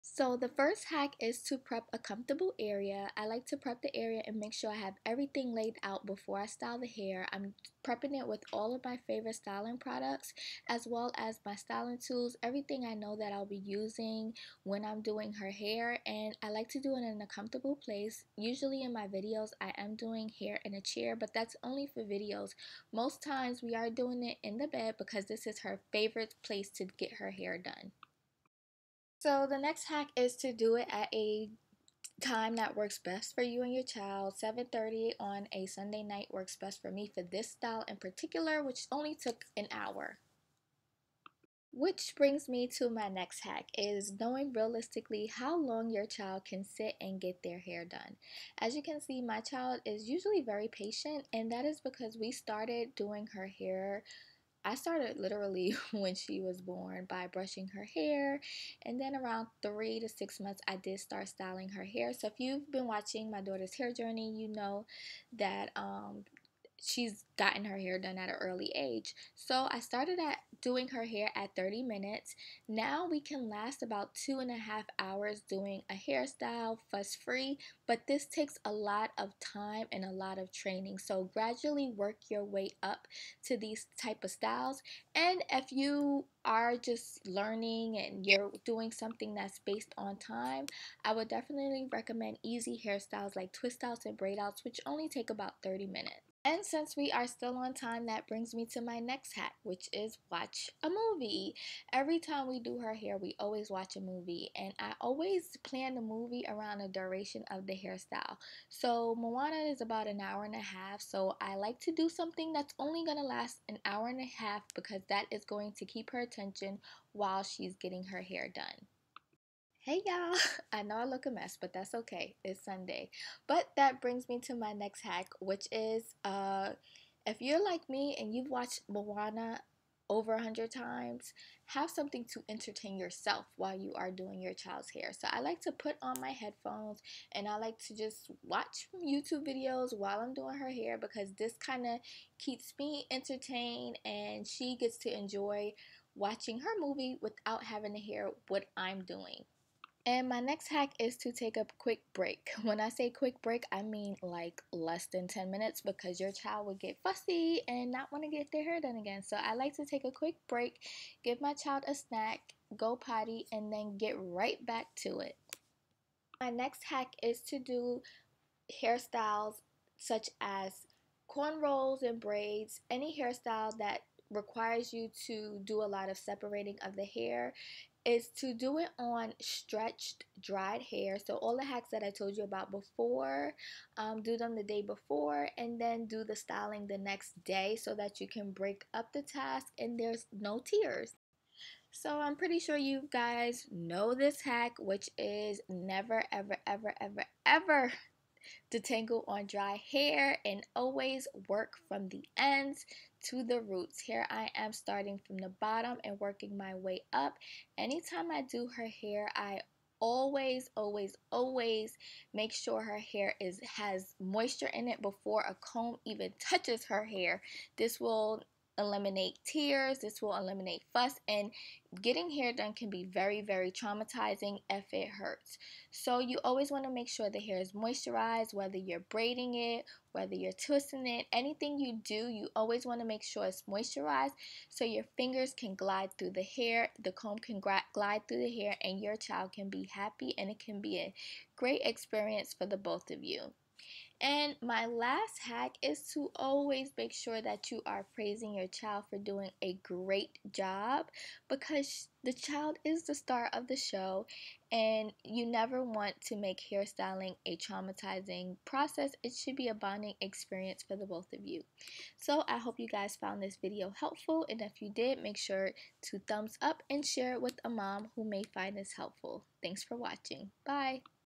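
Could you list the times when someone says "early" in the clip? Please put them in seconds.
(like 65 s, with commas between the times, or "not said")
68 s.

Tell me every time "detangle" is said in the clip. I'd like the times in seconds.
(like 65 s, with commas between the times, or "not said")
198 s.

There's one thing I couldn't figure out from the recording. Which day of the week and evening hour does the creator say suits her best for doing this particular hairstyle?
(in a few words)
7:30 on a Sunday night.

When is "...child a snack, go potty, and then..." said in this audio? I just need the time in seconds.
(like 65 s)
161 s.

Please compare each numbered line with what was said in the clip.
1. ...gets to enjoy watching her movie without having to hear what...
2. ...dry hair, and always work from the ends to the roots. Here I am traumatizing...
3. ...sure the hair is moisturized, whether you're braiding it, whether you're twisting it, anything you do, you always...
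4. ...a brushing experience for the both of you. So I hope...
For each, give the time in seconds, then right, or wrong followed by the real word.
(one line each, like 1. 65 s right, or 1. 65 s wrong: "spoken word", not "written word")
1. 144 s right
2. 199 s wrong: "starting", not "traumatizing"
3. 227 s right
4. 259 s wrong: "bonding", not "brushing".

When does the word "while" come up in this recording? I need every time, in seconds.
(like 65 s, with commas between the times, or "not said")
117 s, 133 s, 139 s.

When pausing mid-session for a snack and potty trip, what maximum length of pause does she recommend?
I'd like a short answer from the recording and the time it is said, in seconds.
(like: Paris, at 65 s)
less than 10 minutes, at 154 s.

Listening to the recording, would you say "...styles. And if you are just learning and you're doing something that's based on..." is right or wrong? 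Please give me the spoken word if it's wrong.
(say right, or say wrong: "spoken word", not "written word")
right.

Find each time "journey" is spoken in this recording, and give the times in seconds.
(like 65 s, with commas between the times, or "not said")
63 s.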